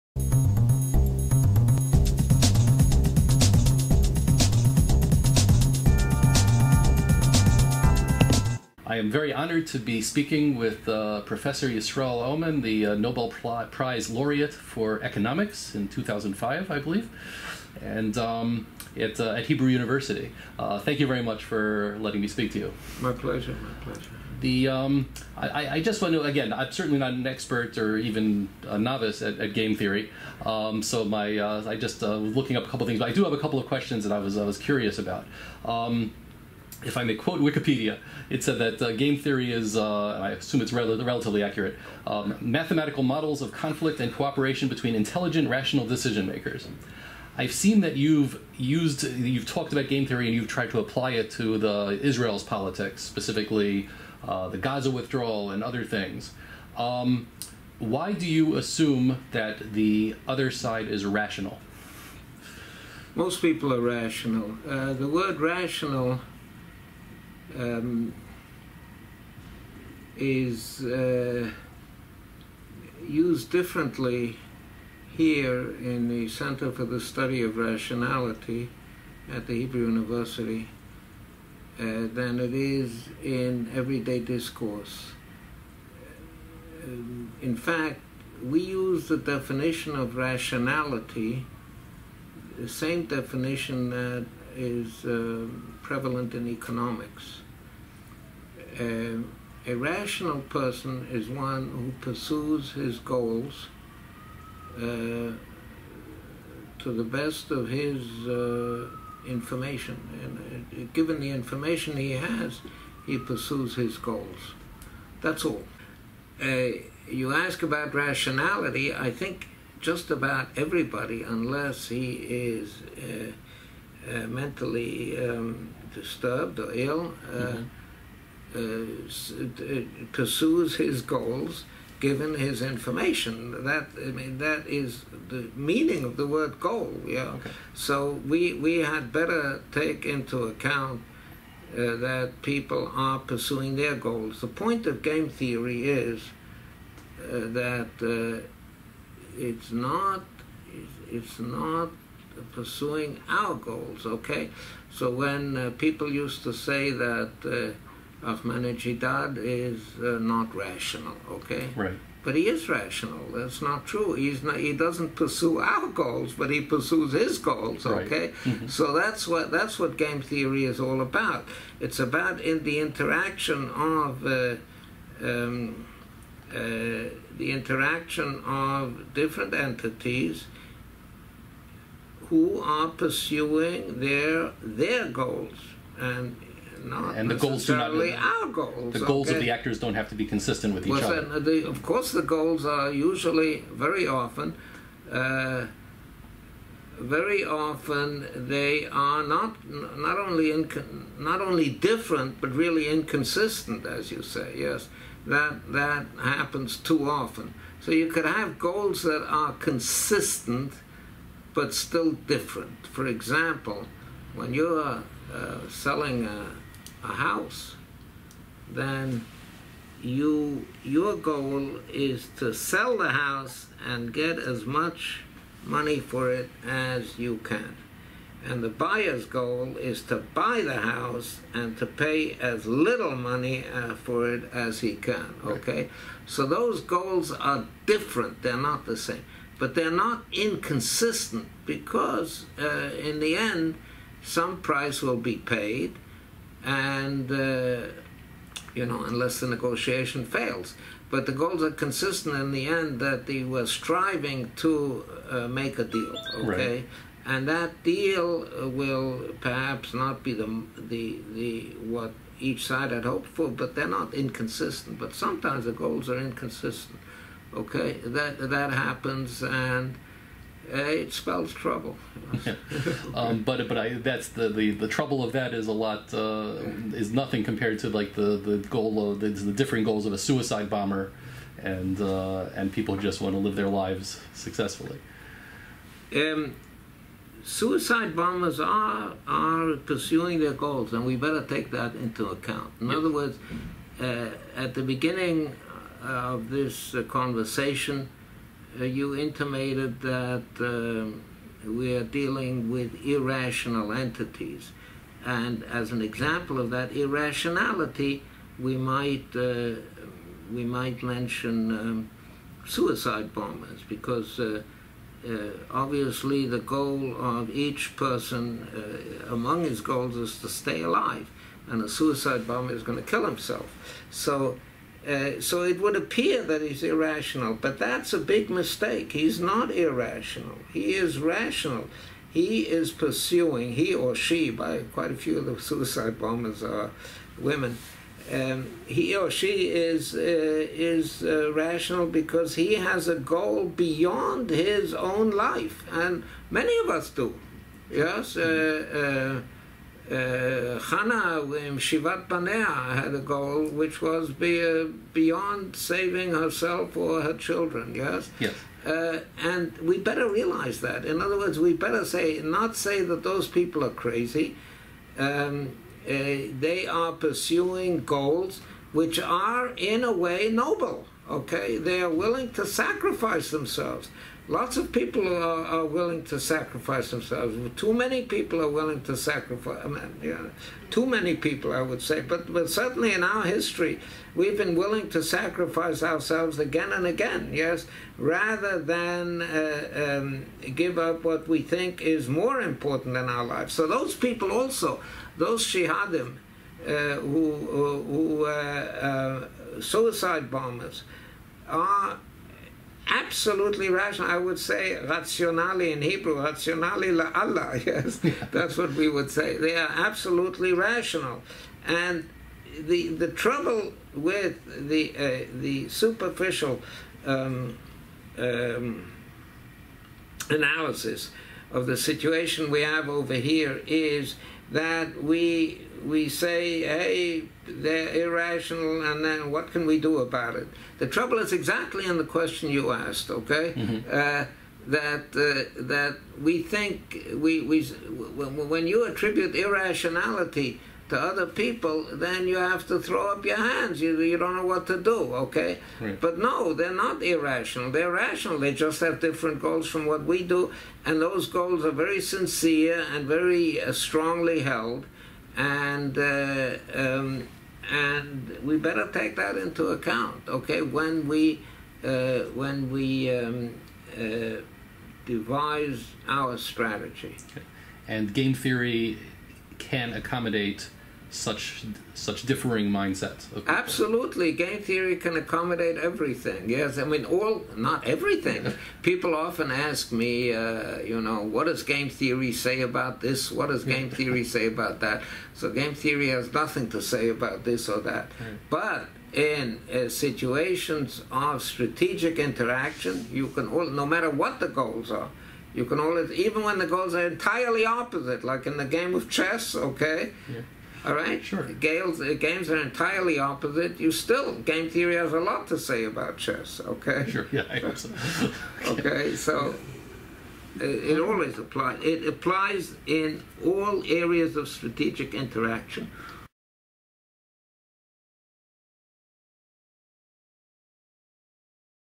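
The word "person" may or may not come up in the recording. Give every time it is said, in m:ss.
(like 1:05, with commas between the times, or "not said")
1:40, 5:17.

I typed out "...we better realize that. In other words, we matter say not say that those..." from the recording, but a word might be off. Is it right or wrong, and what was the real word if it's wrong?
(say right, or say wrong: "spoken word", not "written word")
wrong: "better", not "matter".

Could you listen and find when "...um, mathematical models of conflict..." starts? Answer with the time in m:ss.
0:42.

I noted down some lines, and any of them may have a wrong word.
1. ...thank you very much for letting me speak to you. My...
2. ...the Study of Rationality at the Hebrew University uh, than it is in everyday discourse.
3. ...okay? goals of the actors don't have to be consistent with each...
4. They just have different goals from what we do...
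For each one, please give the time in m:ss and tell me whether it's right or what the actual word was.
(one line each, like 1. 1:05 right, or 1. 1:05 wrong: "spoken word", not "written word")
1. 0:20 right
2. 1:16 right
3. 3:08 right
4. 7:28 right.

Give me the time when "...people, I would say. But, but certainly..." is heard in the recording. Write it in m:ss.
6:21.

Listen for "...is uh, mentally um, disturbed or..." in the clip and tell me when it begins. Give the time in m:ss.
2:02.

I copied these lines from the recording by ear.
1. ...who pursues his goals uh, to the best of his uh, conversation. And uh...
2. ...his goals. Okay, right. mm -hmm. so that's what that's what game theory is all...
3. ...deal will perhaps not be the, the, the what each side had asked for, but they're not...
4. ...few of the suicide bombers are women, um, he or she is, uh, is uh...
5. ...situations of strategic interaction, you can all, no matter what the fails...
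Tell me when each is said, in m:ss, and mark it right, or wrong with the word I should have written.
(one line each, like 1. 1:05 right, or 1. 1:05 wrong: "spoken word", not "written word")
1. 1:41 wrong: "information", not "conversation"
2. 2:47 right
3. 4:17 wrong: "hoped", not "asked"
4. 5:35 right
5. 8:10 wrong: "goals", not "fails".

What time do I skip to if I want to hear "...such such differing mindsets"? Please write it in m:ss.
7:51.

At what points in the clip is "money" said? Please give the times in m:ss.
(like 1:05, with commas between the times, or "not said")
3:45, 3:53.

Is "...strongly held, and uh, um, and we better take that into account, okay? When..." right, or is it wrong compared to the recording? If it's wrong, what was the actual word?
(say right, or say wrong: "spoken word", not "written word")
right.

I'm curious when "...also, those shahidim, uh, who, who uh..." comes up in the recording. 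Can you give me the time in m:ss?
6:34.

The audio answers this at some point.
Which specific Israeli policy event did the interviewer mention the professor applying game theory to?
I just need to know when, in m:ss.
0:54.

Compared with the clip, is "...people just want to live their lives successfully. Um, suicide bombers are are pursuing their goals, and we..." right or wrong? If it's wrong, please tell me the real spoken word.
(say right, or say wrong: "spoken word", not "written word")
right.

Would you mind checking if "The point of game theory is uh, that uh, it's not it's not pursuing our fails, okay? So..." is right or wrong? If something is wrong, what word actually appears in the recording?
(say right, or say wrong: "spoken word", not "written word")
wrong: "goals", not "fails".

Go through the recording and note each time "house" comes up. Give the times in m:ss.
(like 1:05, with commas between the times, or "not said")
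3:37, 3:43, 3:50.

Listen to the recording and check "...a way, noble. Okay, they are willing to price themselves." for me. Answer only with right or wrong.
wrong.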